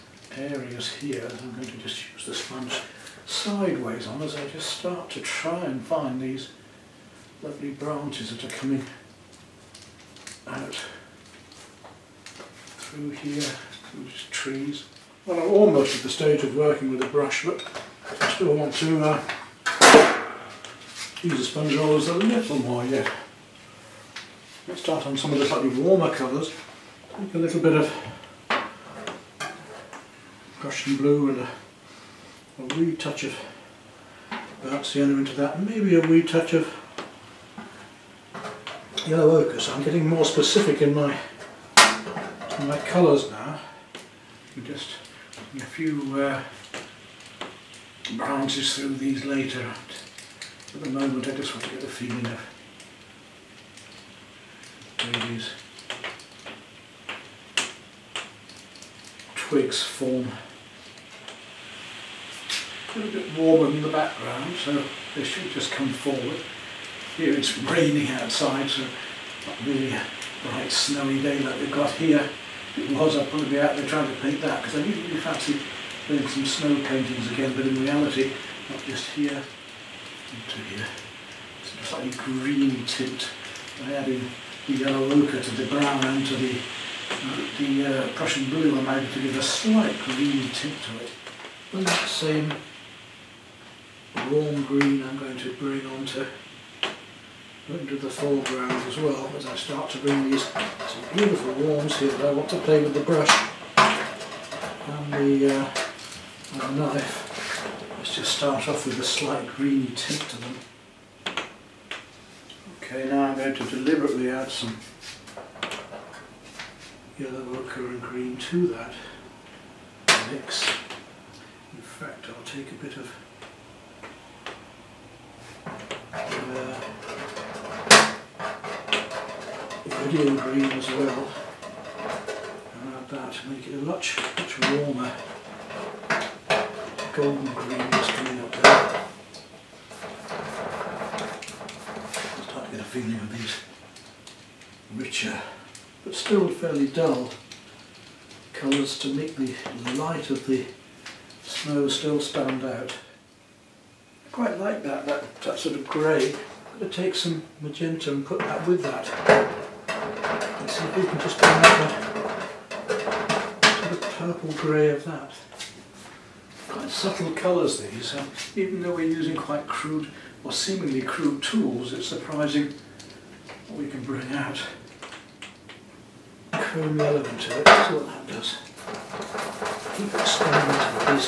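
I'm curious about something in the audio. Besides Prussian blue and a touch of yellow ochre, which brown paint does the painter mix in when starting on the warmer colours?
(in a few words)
Dark sienna.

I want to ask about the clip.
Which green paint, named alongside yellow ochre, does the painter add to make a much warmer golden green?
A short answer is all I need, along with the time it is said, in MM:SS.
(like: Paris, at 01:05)
Purdue green, at 02:10.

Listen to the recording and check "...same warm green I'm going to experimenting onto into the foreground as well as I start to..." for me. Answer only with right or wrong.
wrong.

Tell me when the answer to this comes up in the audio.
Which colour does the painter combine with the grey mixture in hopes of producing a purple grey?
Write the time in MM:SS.
02:37.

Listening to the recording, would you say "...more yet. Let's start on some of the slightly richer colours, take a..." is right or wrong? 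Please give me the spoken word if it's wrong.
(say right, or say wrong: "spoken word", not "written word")
wrong: "warmer", not "richer".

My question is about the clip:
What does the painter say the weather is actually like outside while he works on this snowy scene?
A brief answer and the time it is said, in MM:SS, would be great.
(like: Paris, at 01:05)
Raining, at 01:07.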